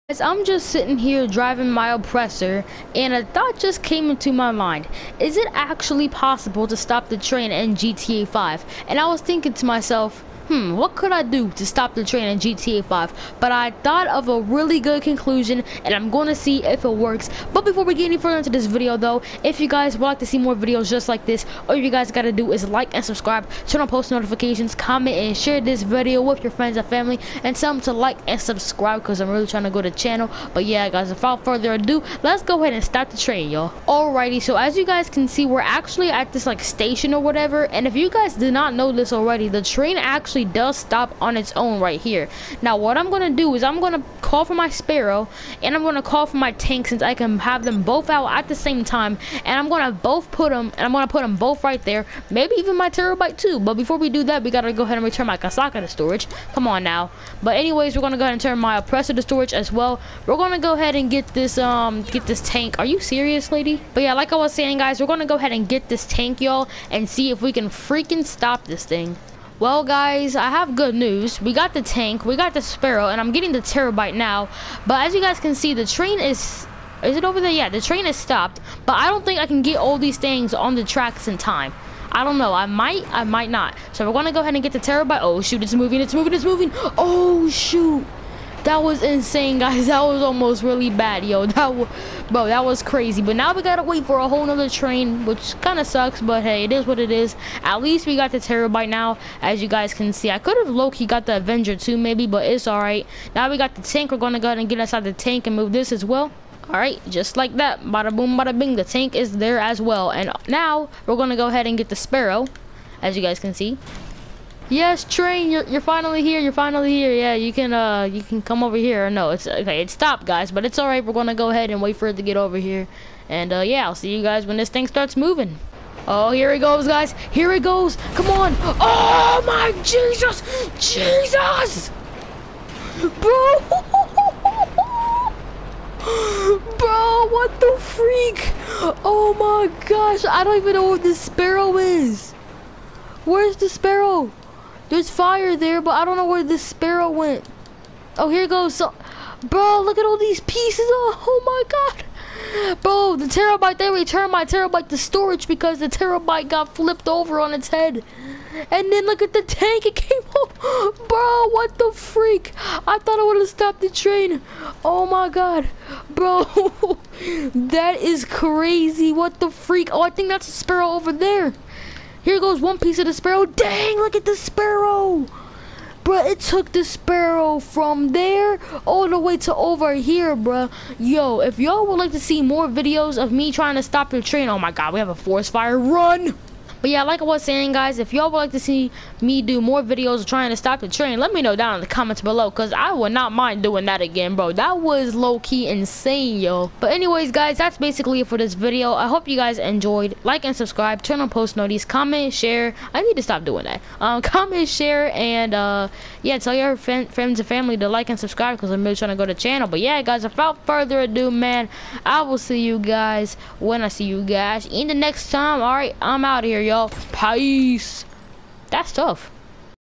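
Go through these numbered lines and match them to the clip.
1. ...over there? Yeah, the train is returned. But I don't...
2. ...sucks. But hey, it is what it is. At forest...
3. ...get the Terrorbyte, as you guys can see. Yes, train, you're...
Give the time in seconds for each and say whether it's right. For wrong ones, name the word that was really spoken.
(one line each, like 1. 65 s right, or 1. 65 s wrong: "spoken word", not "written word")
1. 77 s wrong: "stopped", not "returned"
2. 95 s wrong: "least", not "forest"
3. 111 s wrong: "Sparrow", not "Terrorbyte".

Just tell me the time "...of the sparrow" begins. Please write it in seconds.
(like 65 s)
172 s.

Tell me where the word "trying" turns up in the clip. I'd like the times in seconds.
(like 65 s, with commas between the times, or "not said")
29 s, 183 s, 190 s, 208 s.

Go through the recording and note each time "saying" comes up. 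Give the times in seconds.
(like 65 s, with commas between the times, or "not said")
64 s, 187 s.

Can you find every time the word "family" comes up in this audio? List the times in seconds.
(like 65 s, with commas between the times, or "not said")
26 s, 207 s.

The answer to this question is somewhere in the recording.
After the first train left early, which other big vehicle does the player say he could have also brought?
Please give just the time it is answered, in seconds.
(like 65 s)
101 s.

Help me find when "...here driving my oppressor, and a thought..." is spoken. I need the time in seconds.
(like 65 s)
0 s.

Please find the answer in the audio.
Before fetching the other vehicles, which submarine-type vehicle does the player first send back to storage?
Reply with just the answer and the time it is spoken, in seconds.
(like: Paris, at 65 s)
Kosatka, at 55 s.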